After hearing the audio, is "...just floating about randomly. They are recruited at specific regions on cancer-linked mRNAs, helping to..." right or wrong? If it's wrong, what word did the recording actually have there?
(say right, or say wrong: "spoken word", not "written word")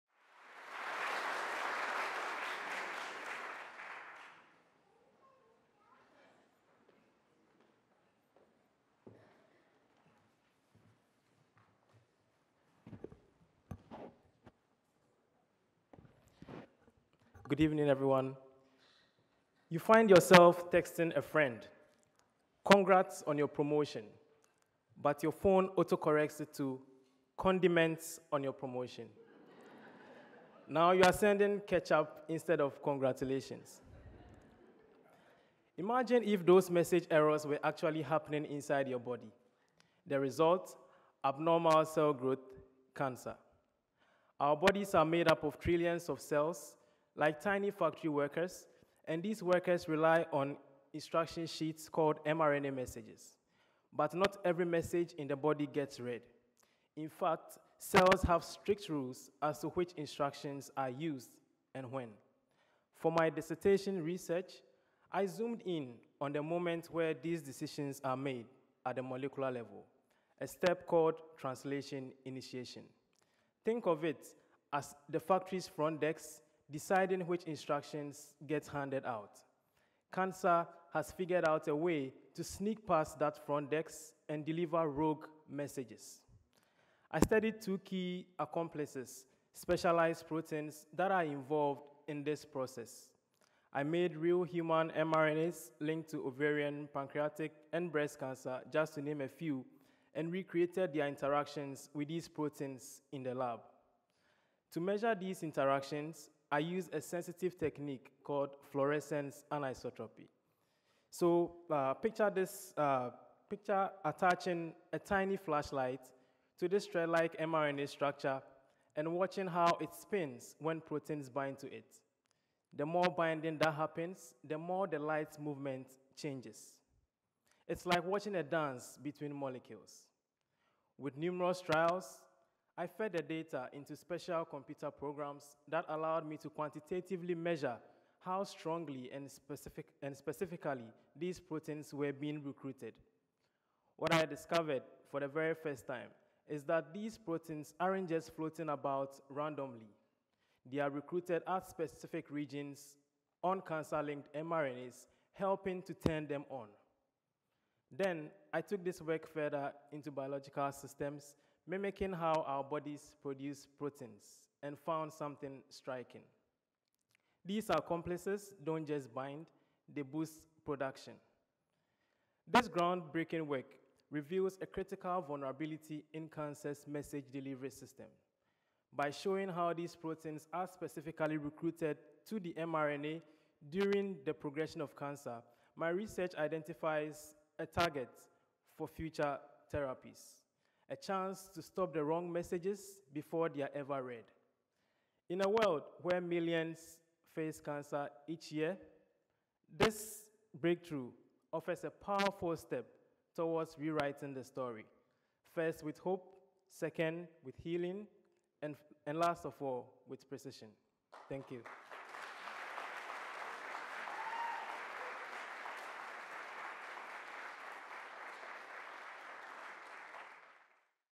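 right.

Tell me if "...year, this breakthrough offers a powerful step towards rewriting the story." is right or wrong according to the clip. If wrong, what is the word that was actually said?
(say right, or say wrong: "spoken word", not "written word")
right.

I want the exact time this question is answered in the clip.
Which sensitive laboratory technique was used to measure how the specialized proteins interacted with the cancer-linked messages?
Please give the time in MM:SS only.
01:48.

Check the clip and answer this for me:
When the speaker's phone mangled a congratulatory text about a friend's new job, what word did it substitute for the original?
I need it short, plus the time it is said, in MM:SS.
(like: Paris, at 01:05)
condiments, at 00:27.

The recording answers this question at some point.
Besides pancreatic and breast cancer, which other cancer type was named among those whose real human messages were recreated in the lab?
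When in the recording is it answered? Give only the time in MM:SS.
01:36.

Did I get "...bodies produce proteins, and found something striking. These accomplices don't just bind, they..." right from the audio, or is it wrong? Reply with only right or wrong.
right.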